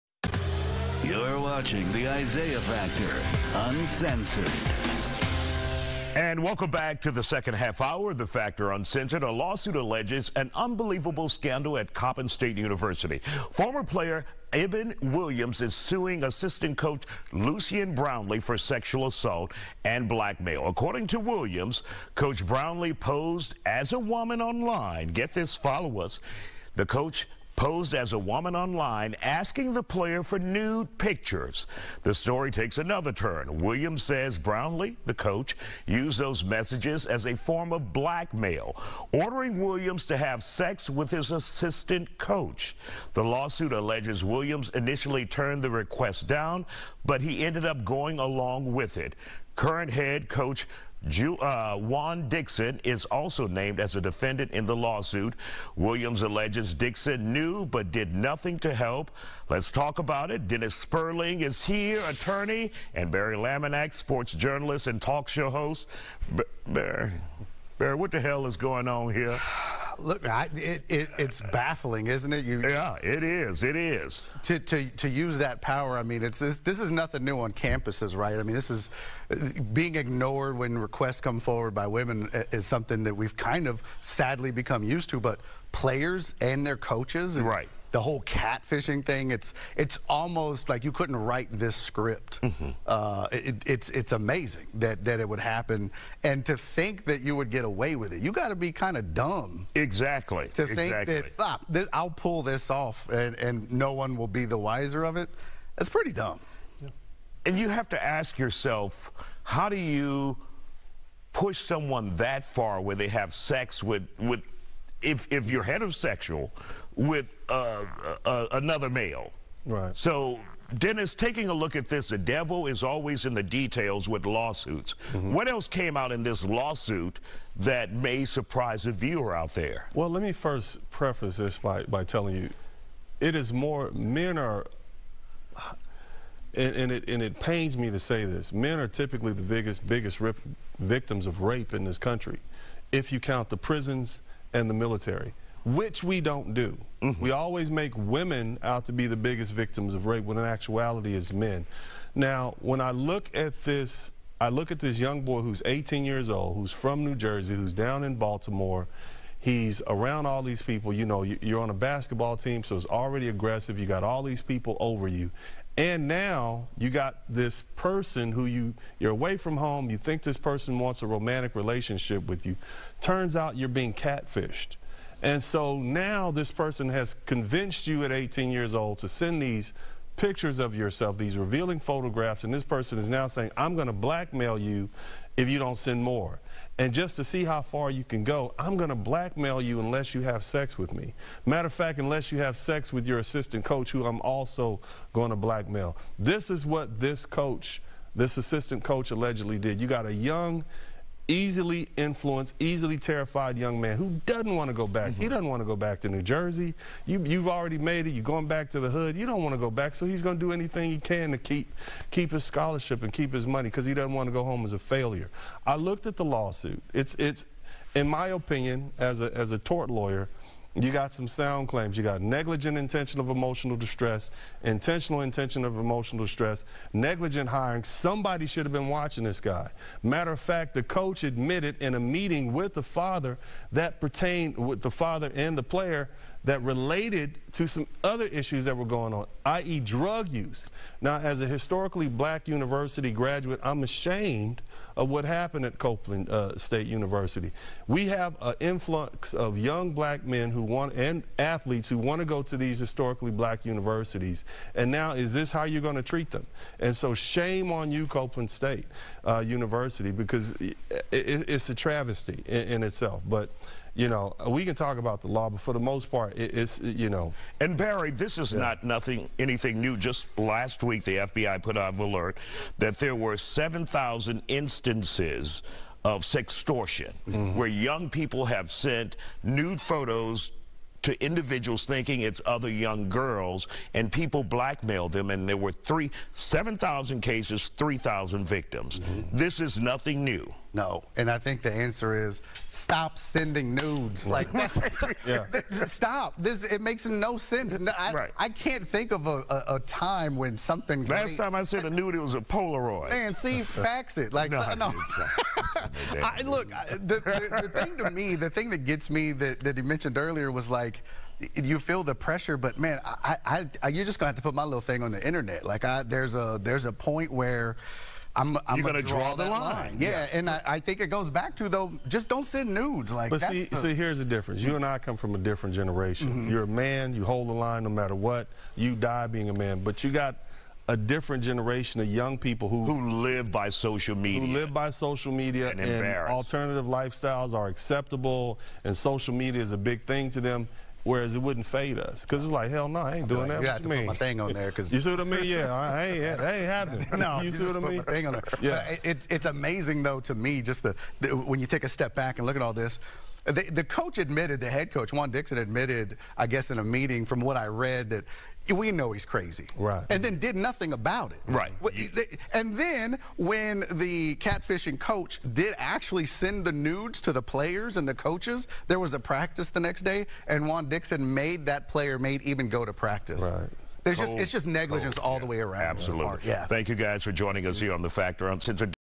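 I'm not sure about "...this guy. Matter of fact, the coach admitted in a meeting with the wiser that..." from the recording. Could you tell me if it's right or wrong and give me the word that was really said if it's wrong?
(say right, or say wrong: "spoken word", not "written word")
wrong: "father", not "wiser".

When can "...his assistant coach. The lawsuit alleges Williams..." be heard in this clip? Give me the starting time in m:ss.
0:41.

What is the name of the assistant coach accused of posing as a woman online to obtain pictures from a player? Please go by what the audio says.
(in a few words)
Lucian Brownlee.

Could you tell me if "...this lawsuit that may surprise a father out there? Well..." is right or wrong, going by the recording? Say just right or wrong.
wrong.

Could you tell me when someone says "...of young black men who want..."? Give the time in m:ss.
4:09.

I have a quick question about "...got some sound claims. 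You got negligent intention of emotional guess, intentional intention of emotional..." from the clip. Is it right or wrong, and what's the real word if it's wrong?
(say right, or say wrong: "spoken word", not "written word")
wrong: "distress", not "guess".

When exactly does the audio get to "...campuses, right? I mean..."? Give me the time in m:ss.
1:17.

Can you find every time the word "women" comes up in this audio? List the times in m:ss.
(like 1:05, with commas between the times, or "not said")
1:21, 2:27.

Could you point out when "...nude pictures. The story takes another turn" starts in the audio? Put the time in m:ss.
0:30.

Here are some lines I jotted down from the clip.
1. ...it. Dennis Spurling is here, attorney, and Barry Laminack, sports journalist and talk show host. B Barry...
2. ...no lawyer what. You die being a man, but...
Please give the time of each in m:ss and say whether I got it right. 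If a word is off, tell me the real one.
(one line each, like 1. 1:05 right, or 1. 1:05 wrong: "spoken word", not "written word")
1. 1:00 right
2. 5:27 wrong: "matter", not "lawyer".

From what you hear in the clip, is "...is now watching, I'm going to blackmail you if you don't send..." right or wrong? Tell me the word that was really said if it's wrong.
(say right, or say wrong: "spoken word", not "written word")
wrong: "saying", not "watching".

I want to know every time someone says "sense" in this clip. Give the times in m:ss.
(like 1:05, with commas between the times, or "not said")
4:57.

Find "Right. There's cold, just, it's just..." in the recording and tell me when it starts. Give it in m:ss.
6:13.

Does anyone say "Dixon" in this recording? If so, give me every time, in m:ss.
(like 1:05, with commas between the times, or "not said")
0:52, 0:56, 5:55, 6:10.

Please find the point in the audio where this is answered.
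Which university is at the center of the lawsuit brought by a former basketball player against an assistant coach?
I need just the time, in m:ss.
0:11.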